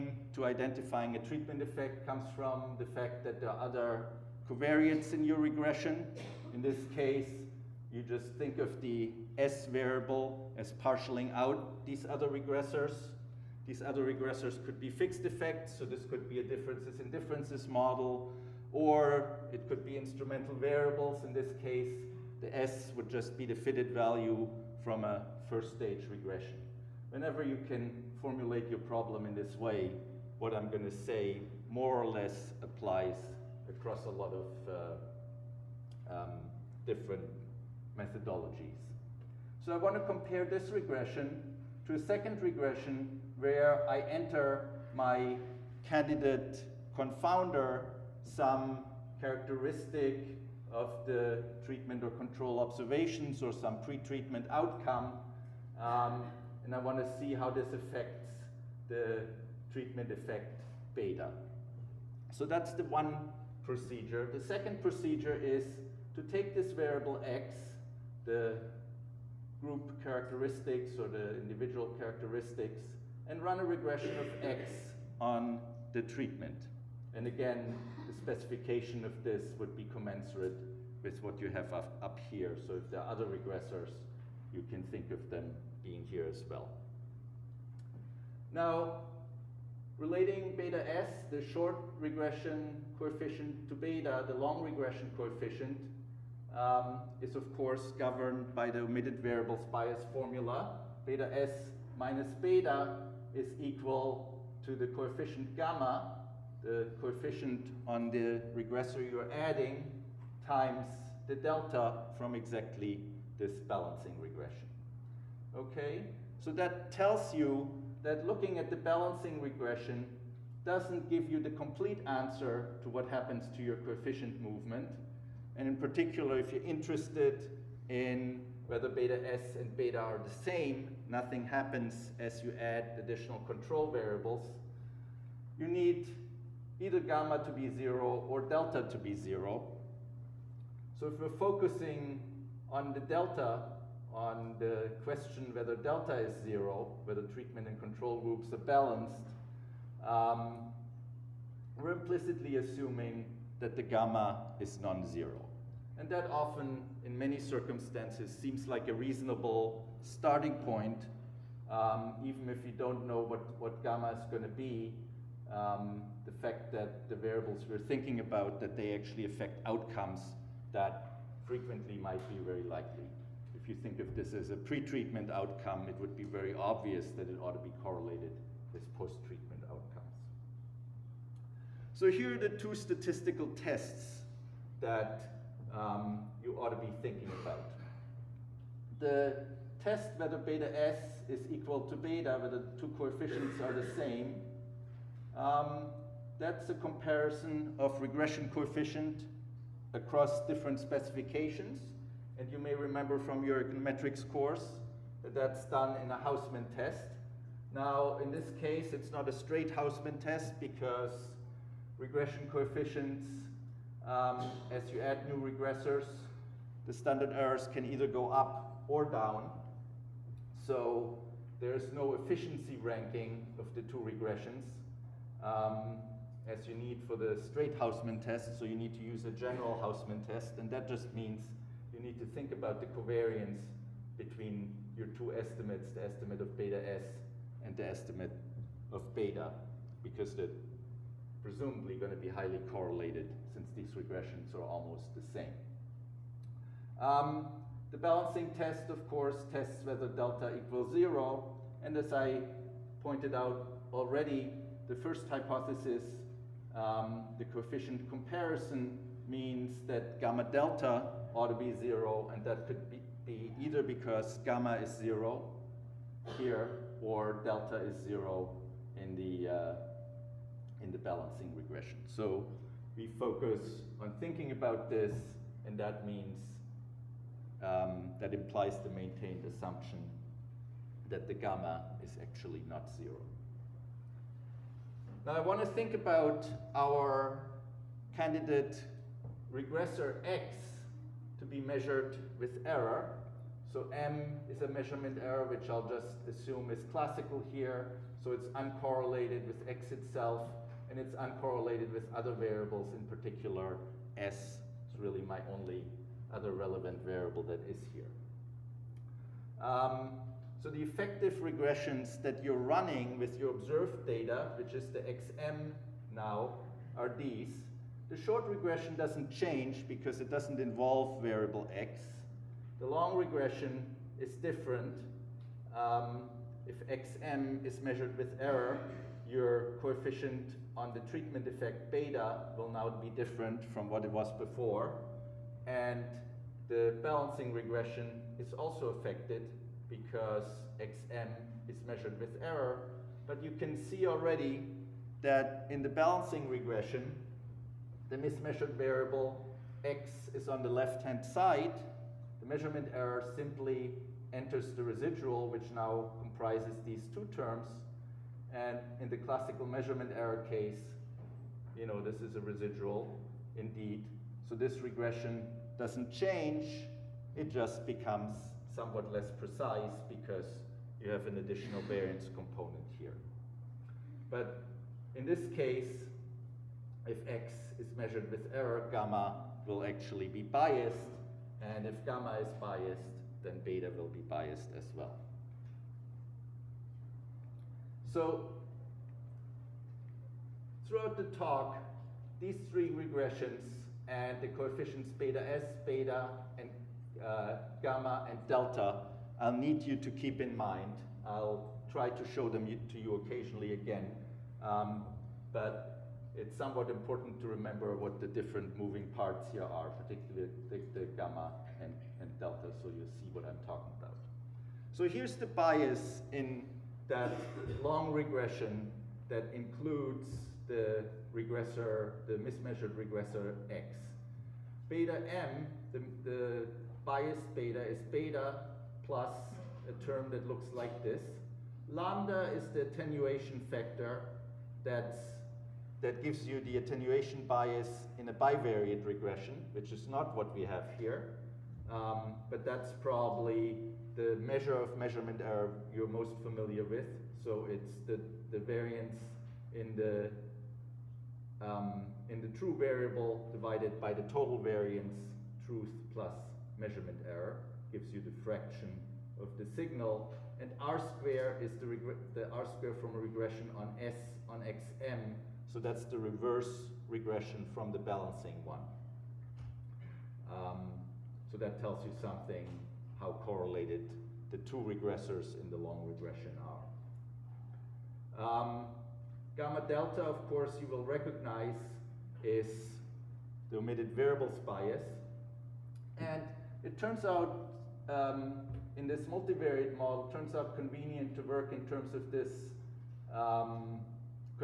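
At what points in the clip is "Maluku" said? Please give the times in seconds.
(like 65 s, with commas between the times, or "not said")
not said.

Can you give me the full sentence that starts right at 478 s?
Um, gamma delta, of course, you will recognize is the omitted variables bias.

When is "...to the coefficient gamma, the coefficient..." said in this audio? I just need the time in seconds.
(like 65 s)
104 s.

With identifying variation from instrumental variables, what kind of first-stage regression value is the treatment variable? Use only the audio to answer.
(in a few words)
fitted value.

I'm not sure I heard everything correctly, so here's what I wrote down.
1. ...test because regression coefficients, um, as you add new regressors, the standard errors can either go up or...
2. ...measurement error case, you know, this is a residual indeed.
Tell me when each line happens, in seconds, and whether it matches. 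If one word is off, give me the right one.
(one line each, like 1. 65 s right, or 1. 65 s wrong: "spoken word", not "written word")
1. 210 s right
2. 359 s right.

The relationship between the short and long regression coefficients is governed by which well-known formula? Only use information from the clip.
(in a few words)
omitted variables bias formula.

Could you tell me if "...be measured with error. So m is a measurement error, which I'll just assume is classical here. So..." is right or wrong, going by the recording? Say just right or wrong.
right.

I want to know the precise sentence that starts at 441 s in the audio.
Um, but that's probably the measure of measurement error you're most familiar with.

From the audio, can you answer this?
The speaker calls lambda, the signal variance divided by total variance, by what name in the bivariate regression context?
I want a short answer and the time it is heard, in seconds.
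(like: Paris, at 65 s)
attenuation factor, at 432 s.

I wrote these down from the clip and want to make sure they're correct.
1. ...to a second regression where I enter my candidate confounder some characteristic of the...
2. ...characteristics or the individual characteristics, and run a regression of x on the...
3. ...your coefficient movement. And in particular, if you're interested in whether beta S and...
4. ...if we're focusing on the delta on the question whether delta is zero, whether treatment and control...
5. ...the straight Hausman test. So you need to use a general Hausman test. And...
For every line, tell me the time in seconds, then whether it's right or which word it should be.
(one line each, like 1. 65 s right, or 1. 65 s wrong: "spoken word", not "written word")
1. 41 s right
2. 70 s right
3. 123 s right
4. 141 s right
5. 227 s right.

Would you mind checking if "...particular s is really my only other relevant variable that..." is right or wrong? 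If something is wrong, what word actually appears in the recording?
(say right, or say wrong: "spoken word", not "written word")
right.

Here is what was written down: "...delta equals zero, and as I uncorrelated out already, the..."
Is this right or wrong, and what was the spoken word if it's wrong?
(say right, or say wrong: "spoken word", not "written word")
wrong: "pointed", not "uncorrelated".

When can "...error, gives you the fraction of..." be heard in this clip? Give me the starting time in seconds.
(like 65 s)
457 s.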